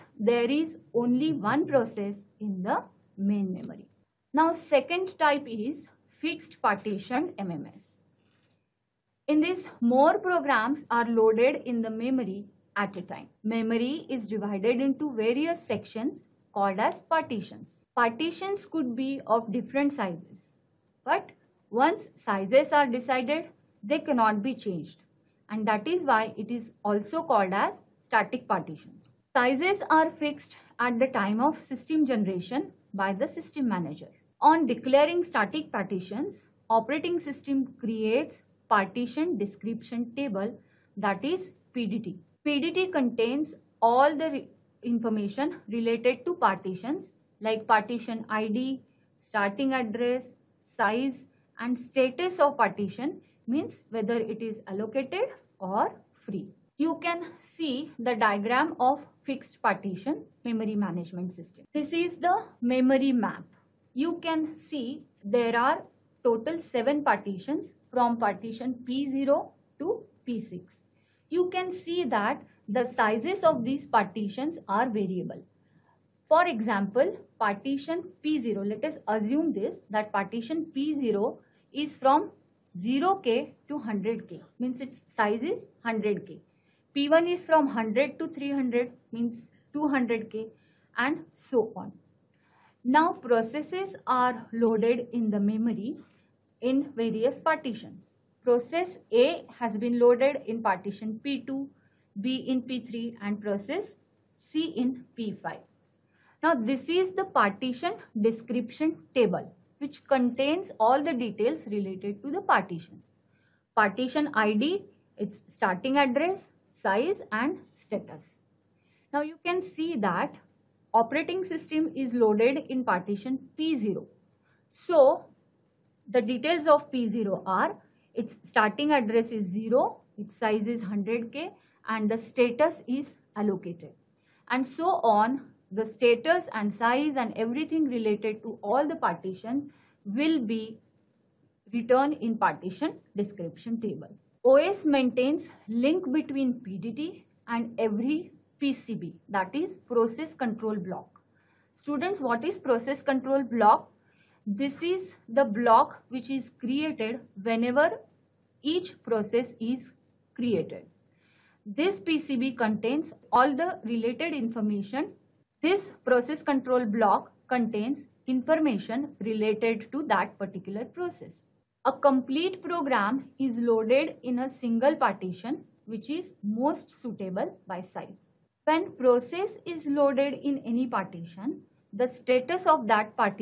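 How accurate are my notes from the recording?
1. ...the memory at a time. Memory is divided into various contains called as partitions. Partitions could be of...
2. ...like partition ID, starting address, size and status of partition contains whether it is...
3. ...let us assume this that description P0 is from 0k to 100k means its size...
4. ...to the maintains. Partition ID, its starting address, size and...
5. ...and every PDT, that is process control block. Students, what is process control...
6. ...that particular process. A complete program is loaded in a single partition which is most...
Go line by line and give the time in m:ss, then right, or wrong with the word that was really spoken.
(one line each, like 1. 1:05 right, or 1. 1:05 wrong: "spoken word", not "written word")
1. 0:11 wrong: "sections", not "contains"
2. 0:47 wrong: "means", not "contains"
3. 1:18 wrong: "partition", not "description"
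4. 1:52 wrong: "partitions", not "maintains"
5. 2:27 wrong: "PCB", not "PDT"
6. 2:50 right.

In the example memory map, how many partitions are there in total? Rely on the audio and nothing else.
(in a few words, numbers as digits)
7.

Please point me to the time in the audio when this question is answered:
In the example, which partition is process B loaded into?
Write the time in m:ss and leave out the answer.
1:42.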